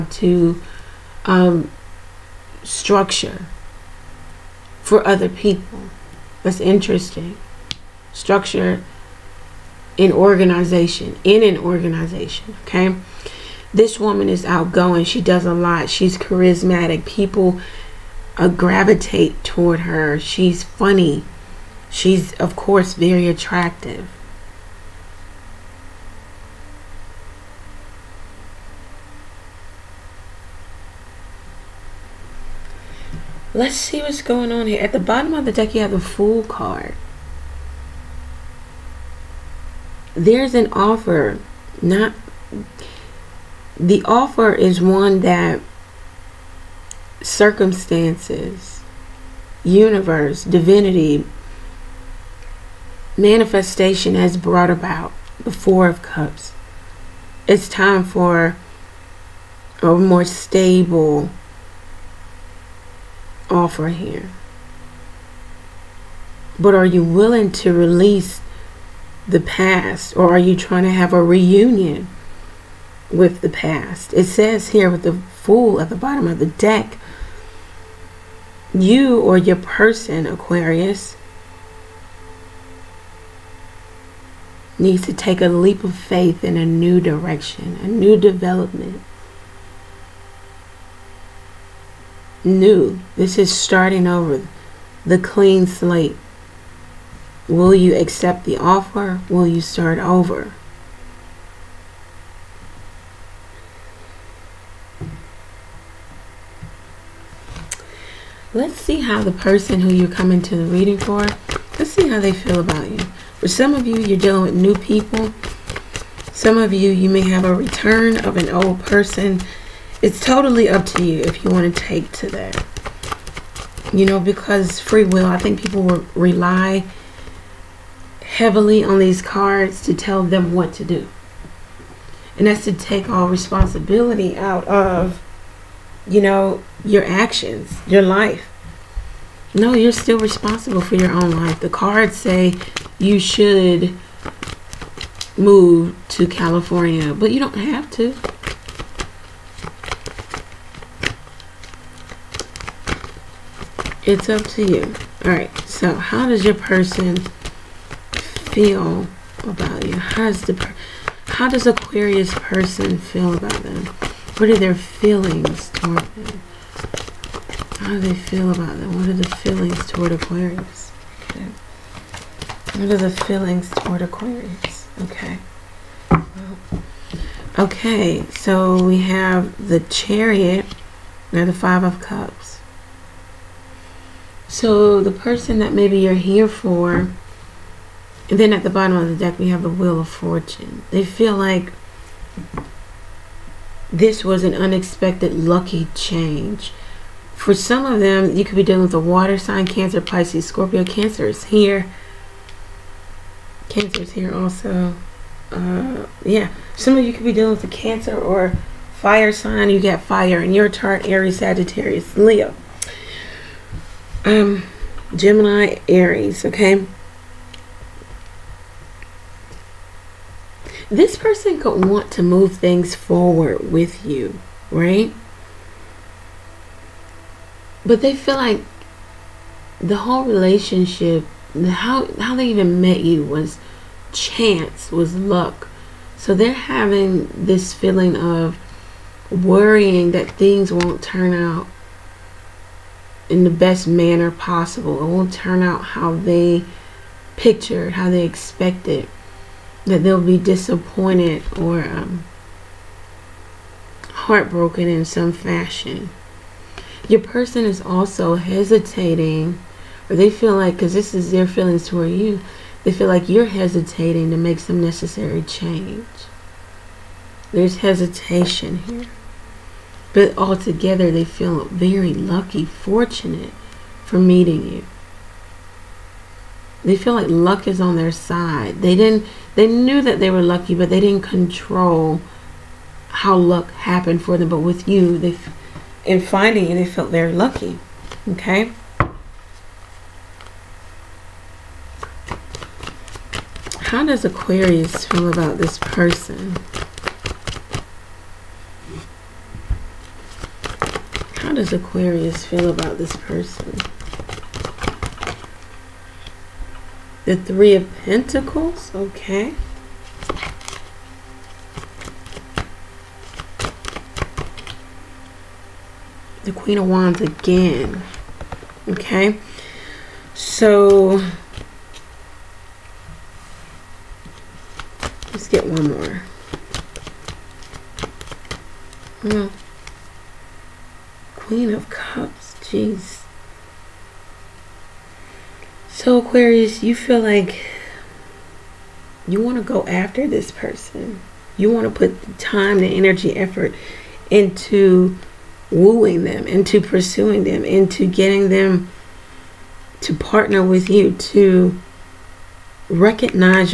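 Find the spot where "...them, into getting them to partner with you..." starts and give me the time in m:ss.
5:47.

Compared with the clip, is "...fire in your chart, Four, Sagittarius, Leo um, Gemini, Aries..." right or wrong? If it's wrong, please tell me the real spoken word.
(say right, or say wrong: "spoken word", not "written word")
wrong: "Aries", not "Four".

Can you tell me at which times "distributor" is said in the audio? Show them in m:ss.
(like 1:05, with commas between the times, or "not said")
not said.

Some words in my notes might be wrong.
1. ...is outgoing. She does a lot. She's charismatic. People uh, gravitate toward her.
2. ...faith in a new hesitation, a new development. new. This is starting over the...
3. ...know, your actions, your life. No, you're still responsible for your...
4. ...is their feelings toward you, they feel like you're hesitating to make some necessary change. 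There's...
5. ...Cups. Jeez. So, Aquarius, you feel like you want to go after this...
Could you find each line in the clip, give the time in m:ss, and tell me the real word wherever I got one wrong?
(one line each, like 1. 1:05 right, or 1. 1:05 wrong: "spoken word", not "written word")
1. 0:14 right
2. 1:25 wrong: "direction", not "hesitation"
3. 2:16 right
4. 4:21 right
5. 5:31 right.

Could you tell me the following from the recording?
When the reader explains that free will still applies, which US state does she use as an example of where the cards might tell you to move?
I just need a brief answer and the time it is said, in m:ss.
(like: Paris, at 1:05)
California, at 2:26.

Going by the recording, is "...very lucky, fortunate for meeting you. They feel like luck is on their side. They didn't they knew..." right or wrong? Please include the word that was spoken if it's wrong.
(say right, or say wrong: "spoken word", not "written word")
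right.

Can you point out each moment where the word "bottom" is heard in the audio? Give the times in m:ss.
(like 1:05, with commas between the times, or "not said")
0:35, 1:15, 3:08.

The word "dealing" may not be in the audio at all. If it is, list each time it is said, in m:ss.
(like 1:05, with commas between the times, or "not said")
1:54, 3:18, 3:27.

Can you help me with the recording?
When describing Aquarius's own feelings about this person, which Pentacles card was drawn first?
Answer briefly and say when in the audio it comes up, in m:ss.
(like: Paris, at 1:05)
Three of Pentacles, at 5:07.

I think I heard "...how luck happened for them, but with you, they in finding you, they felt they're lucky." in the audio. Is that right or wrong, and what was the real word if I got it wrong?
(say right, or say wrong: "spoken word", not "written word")
right.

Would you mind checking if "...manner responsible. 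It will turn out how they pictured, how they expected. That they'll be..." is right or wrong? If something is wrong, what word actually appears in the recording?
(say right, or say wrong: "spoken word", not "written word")
wrong: "possible", not "responsible".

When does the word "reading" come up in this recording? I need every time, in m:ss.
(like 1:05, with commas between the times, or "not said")
1:50.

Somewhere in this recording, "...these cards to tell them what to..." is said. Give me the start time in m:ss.
2:08.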